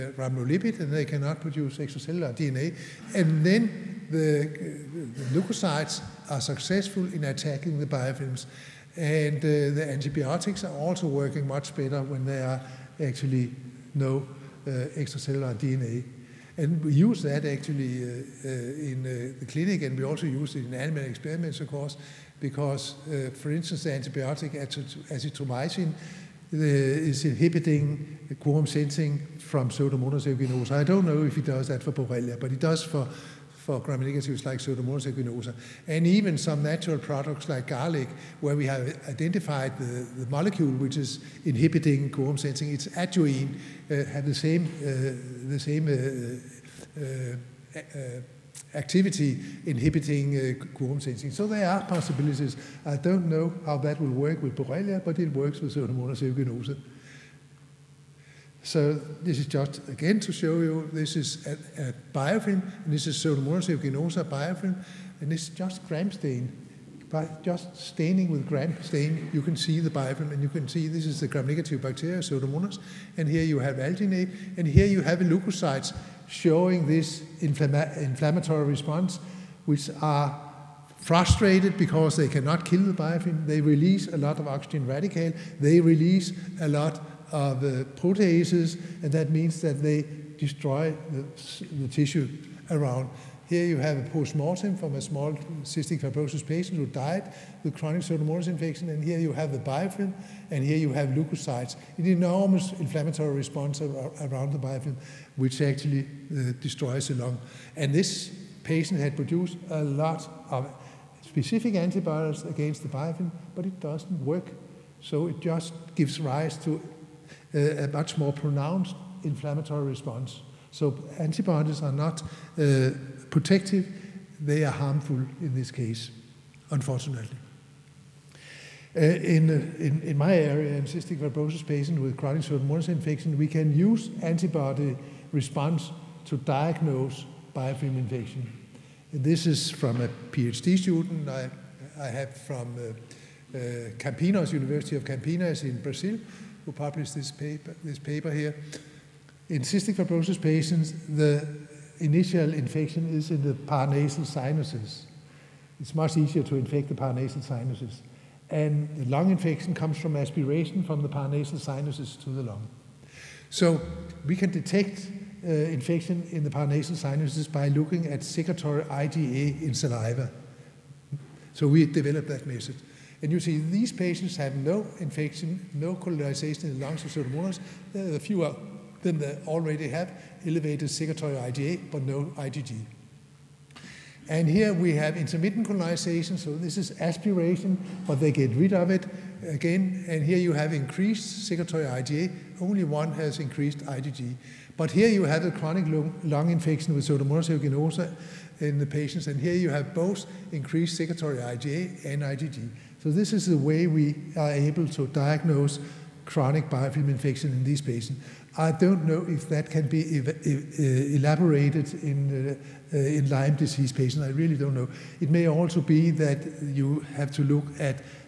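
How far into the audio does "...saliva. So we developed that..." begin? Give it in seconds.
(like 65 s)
169 s.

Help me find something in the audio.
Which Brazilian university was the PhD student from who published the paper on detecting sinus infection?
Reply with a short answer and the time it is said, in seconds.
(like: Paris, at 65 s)
University of Campinas, at 144 s.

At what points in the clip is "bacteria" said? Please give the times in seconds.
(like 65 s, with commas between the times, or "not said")
71 s.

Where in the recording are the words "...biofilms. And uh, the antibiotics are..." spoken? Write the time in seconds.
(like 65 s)
7 s.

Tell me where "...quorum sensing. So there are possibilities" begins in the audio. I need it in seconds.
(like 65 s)
50 s.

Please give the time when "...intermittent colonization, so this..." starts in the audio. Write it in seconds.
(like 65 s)
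185 s.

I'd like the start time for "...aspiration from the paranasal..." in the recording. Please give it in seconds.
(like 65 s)
160 s.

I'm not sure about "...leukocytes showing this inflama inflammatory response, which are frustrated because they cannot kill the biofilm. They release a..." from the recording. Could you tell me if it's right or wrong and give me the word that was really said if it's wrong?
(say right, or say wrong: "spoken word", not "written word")
right.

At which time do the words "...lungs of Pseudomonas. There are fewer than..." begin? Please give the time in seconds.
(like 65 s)
176 s.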